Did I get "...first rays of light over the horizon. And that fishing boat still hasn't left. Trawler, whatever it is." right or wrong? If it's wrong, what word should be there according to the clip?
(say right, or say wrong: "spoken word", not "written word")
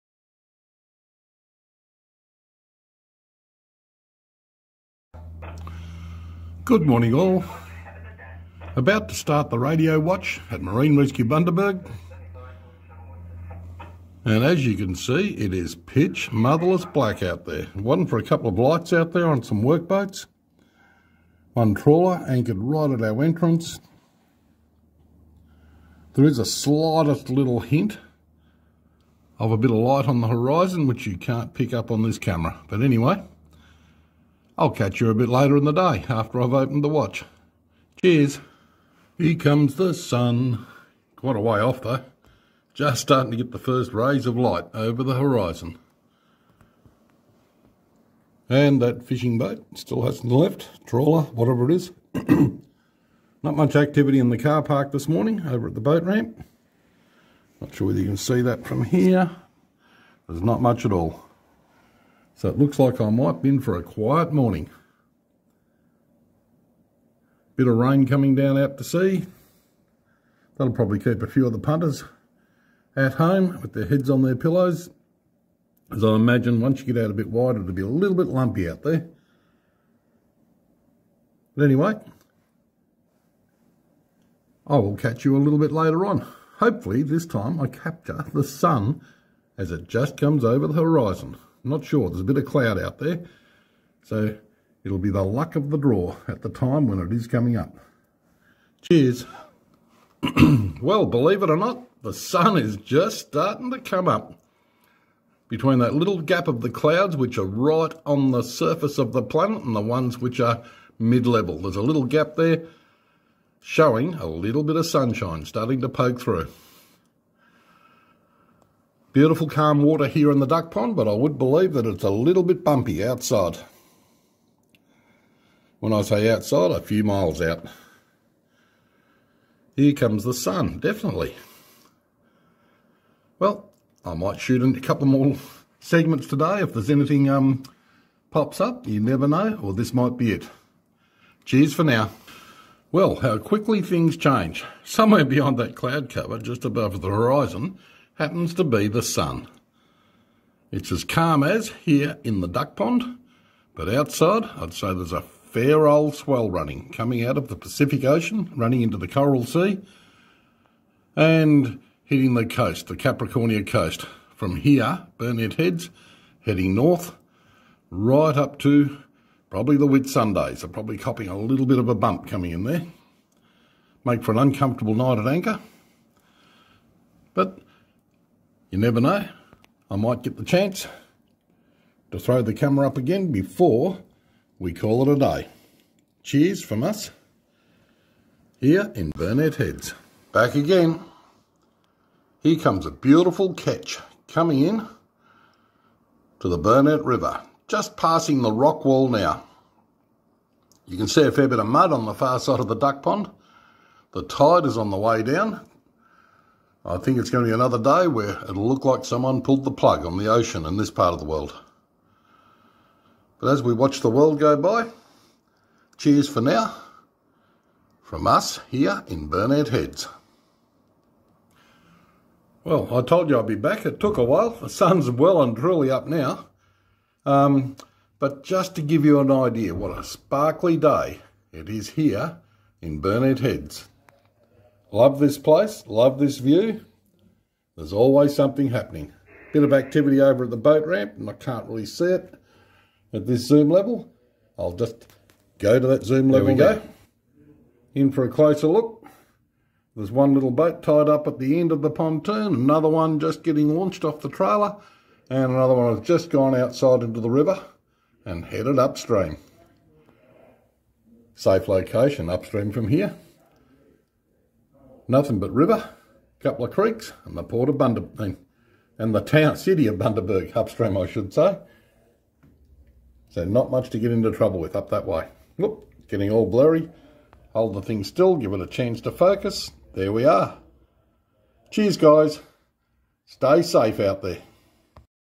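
right.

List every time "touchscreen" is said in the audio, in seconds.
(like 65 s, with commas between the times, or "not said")
not said.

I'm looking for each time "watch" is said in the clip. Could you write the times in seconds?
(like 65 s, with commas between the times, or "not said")
9 s, 36 s, 213 s.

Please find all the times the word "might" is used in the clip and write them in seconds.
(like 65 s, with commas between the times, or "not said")
63 s, 134 s, 139 s, 179 s.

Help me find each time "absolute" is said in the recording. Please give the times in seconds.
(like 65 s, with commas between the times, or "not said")
not said.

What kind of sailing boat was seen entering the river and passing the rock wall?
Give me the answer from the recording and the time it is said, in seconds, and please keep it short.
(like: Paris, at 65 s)
Ketch, at 193 s.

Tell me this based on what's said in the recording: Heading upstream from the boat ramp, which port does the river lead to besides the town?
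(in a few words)
Port of Bundaberg.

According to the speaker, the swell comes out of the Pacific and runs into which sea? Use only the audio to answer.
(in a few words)
Coral Sea.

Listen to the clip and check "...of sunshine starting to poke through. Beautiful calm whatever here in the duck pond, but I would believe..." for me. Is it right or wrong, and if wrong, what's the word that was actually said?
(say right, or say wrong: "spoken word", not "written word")
wrong: "water", not "whatever".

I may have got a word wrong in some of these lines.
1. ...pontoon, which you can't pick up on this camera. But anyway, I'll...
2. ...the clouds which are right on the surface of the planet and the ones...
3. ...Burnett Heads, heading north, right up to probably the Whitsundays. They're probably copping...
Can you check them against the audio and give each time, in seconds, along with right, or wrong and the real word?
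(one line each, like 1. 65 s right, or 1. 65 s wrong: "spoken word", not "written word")
1. 30 s wrong: "horizon", not "pontoon"
2. 106 s right
3. 165 s right.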